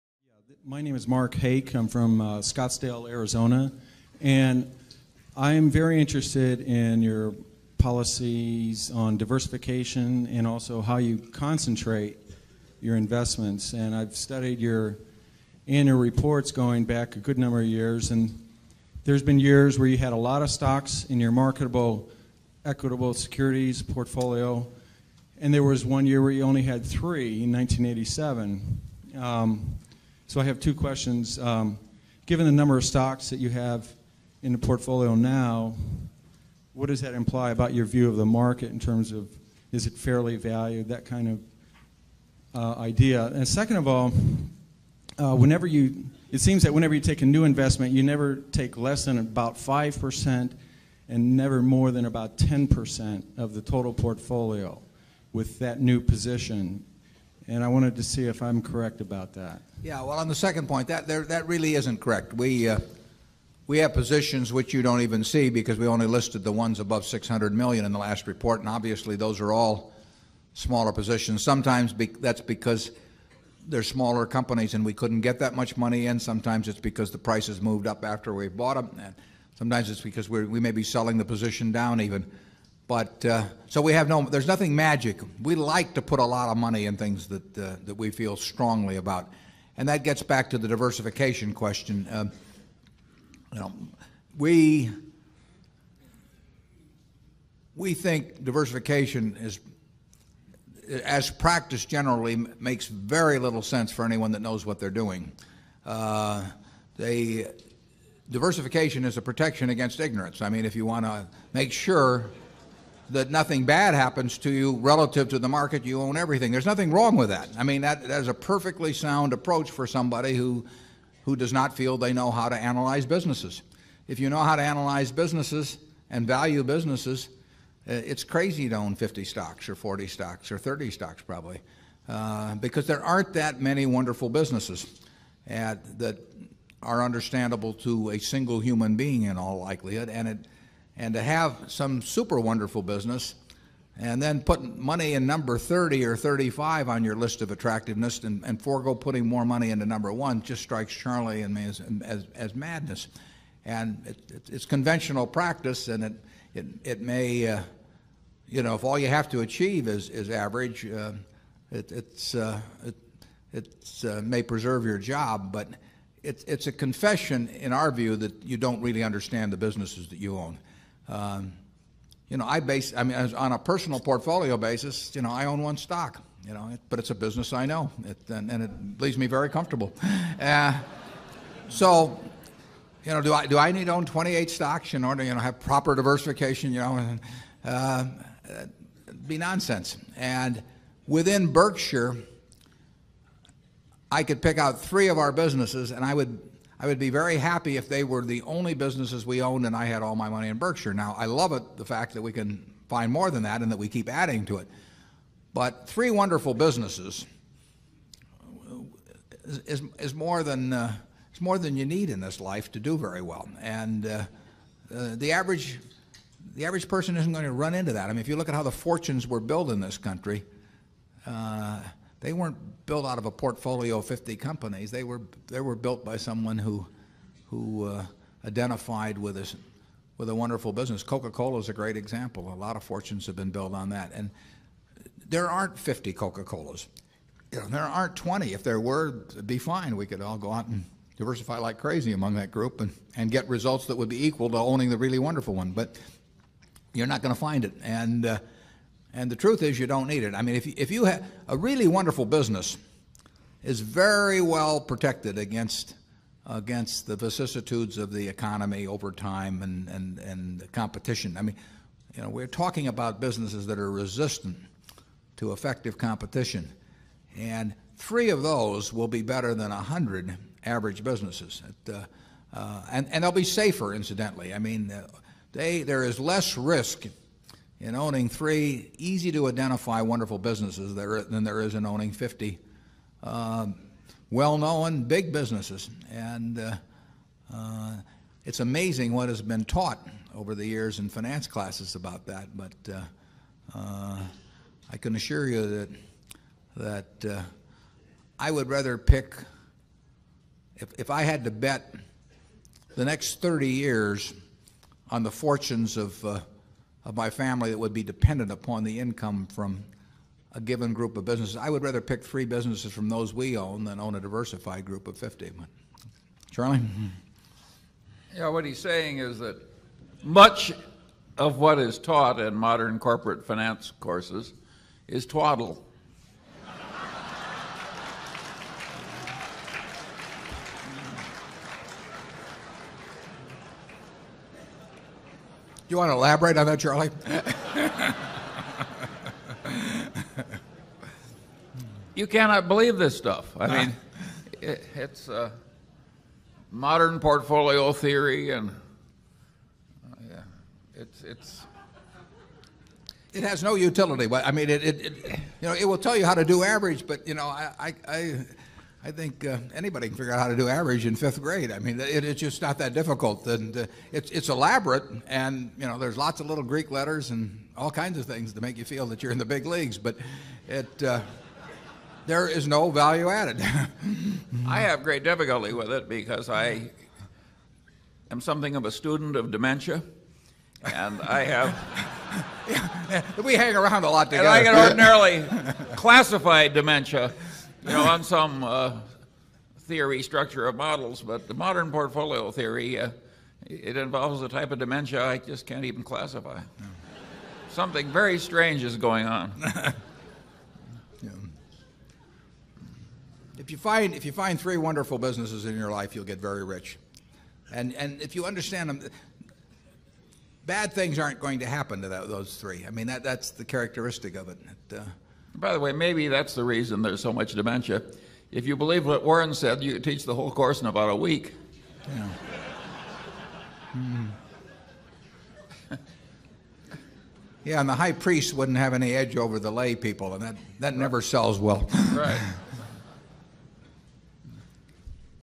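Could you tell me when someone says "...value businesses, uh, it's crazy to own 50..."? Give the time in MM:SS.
02:06.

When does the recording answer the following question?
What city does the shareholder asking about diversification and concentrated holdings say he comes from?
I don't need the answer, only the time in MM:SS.
00:02.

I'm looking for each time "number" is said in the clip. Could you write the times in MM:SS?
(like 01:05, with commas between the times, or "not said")
00:17, 00:32, 02:25, 02:29.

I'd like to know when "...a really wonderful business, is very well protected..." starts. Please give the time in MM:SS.
04:11.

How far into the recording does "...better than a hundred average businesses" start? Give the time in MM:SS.
04:29.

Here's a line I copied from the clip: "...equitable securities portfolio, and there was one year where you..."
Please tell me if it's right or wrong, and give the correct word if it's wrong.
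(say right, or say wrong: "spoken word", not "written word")
right.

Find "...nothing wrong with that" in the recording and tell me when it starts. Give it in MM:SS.
01:56.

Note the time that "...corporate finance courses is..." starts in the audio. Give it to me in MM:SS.
05:22.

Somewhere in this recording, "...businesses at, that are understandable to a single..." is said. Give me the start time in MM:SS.
02:14.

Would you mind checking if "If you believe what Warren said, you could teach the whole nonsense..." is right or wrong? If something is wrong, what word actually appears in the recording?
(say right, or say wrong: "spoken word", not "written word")
wrong: "course", not "nonsense".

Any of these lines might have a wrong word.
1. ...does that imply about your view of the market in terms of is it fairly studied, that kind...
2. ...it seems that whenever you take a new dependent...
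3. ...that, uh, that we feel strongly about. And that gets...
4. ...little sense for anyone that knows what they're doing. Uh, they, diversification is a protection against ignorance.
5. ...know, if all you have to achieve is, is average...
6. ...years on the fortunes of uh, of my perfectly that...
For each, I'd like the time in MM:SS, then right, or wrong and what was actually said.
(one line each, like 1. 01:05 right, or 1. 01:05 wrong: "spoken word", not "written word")
1. 00:36 wrong: "valued", not "studied"
2. 00:46 wrong: "investment", not "dependent"
3. 01:27 right
4. 01:43 right
5. 02:38 right
6. 05:03 wrong: "family", not "perfectly".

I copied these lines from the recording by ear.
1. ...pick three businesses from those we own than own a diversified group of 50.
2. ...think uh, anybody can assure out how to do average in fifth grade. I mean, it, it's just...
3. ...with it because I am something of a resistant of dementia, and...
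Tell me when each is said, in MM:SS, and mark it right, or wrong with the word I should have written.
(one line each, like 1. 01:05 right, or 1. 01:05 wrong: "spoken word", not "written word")
1. 05:12 right
2. 05:59 wrong: "figure", not "assure"
3. 06:15 wrong: "student", not "resistant".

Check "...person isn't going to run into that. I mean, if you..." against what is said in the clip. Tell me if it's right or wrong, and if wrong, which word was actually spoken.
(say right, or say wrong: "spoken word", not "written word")
right.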